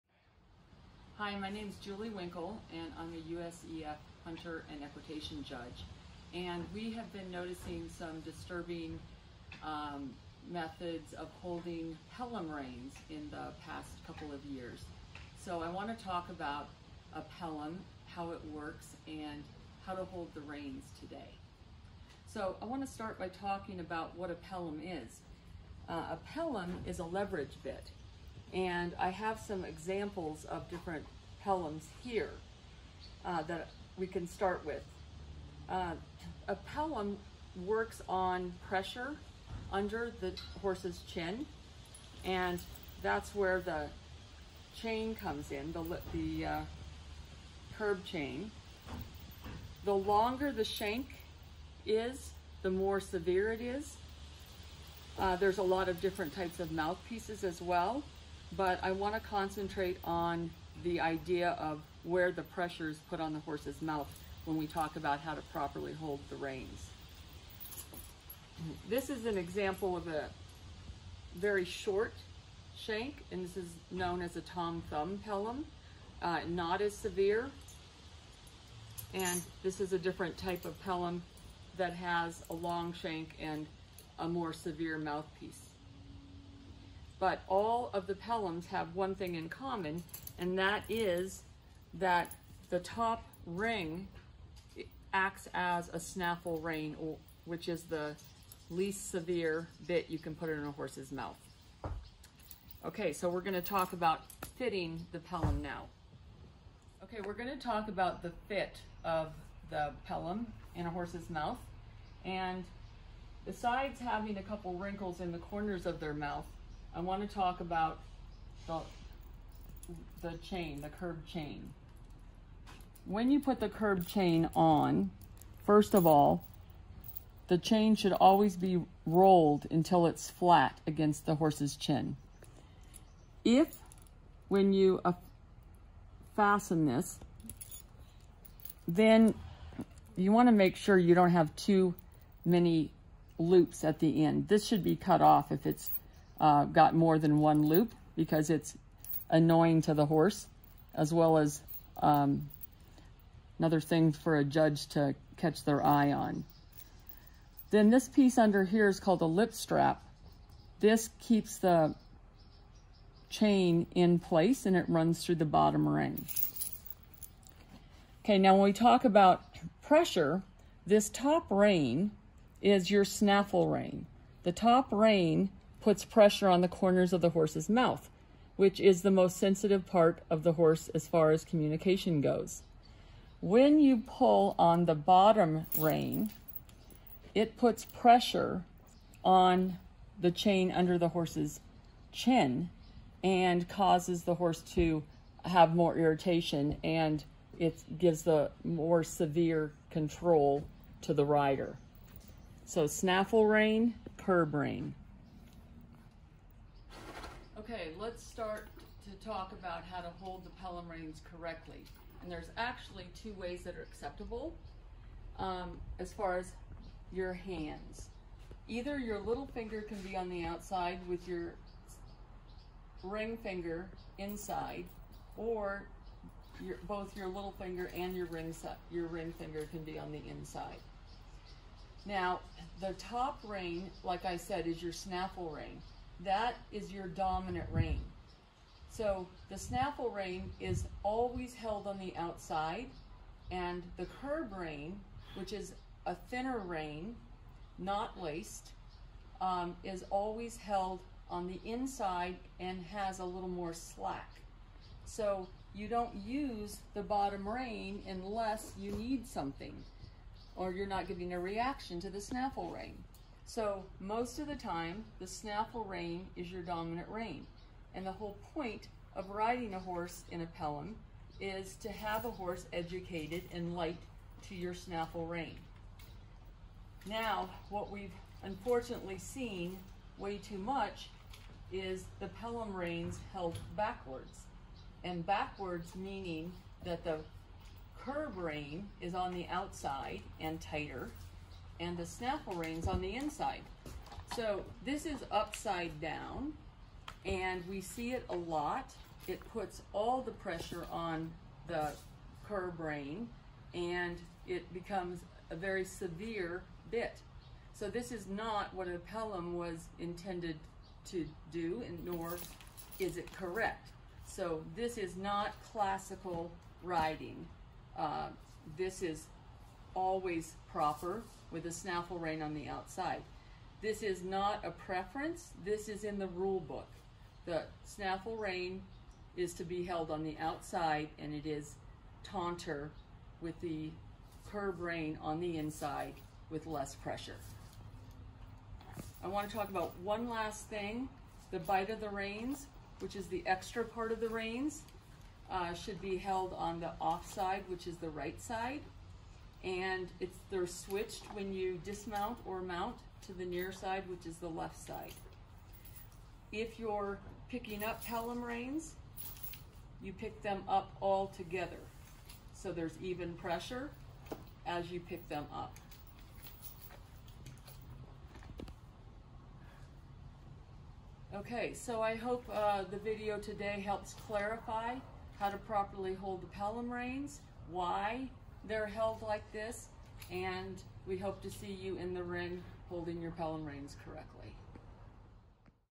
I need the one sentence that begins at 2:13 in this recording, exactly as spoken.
If, when you uh, fasten this, then you want to make sure you don't have too many loops at the end.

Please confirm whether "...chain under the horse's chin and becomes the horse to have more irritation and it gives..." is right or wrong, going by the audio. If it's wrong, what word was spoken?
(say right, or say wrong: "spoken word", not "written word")
wrong: "causes", not "becomes".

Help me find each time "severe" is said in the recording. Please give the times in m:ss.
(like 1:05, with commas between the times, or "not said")
0:52, 1:16, 1:24, 1:39, 3:19, 5:05.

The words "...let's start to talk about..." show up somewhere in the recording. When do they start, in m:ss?
3:27.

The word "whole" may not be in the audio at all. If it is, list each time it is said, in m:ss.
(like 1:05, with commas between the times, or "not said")
4:28.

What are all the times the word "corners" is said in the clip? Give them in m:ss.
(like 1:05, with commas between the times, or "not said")
1:55, 2:56.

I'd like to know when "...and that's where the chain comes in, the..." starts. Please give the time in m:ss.
0:42.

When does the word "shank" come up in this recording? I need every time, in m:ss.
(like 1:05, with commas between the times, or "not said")
0:50, 1:12, 1:22.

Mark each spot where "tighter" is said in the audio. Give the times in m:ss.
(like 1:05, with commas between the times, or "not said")
4:50.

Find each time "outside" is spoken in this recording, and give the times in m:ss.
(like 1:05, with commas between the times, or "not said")
3:40, 4:02, 4:49, 5:22, 5:30.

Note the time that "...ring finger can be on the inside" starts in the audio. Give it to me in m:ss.
3:49.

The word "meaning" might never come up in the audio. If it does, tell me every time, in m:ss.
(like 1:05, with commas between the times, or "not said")
4:45.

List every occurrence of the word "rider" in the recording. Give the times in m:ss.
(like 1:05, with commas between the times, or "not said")
3:21.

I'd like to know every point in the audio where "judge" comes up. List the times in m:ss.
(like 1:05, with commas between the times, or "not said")
0:05, 2:34.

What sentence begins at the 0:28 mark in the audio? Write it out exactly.
And I have some examples of different pelhams here uh, that we can start with.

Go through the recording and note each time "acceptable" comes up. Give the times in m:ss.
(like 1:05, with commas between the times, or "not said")
3:33.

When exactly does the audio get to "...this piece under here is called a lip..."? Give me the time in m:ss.
2:37.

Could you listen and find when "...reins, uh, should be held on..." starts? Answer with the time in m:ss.
5:44.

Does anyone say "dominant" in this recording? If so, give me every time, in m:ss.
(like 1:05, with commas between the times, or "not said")
3:57, 4:26.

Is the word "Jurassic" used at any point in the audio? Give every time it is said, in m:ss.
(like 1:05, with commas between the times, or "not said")
not said.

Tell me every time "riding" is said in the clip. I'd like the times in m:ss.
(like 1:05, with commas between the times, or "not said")
4:29, 5:16.